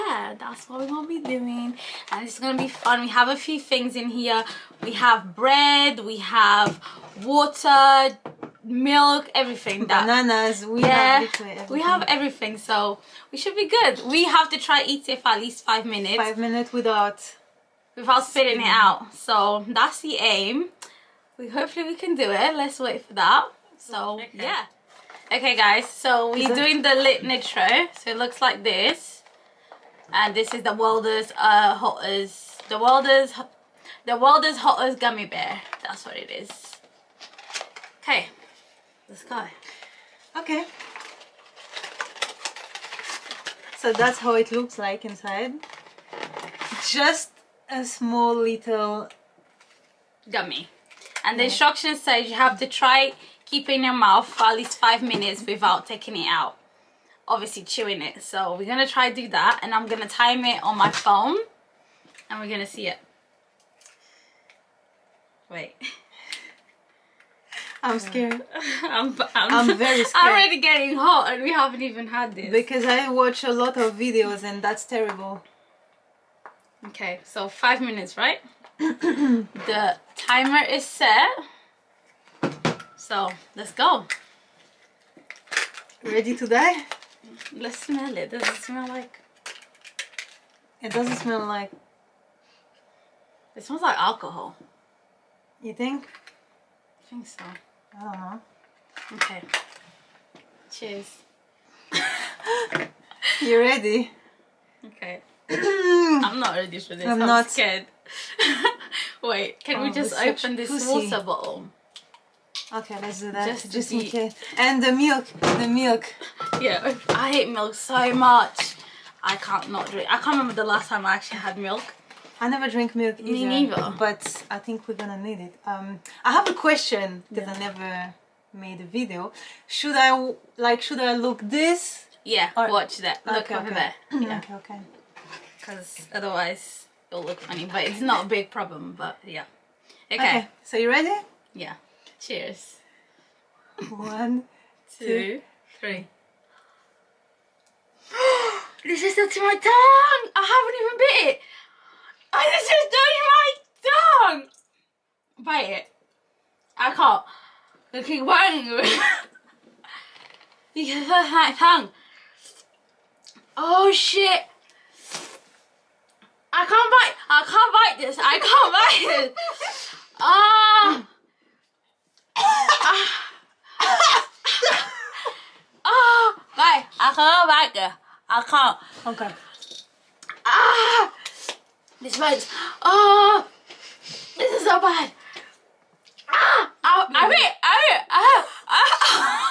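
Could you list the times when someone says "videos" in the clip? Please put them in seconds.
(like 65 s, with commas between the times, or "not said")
73 s, 128 s.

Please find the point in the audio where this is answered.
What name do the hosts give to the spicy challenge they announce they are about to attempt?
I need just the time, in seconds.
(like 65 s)
26 s.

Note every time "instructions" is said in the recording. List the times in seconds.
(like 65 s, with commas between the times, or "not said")
51 s.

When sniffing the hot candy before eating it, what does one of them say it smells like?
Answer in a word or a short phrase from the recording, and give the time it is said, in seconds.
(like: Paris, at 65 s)
Alcohol, at 93 s.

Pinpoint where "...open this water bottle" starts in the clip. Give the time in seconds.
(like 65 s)
110 s.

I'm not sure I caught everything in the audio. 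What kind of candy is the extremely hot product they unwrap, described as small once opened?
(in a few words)
Gummy bear.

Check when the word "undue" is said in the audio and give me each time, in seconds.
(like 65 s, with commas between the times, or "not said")
not said.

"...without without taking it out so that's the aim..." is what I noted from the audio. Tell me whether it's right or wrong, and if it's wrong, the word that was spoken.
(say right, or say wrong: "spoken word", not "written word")
wrong: "spitting", not "taking".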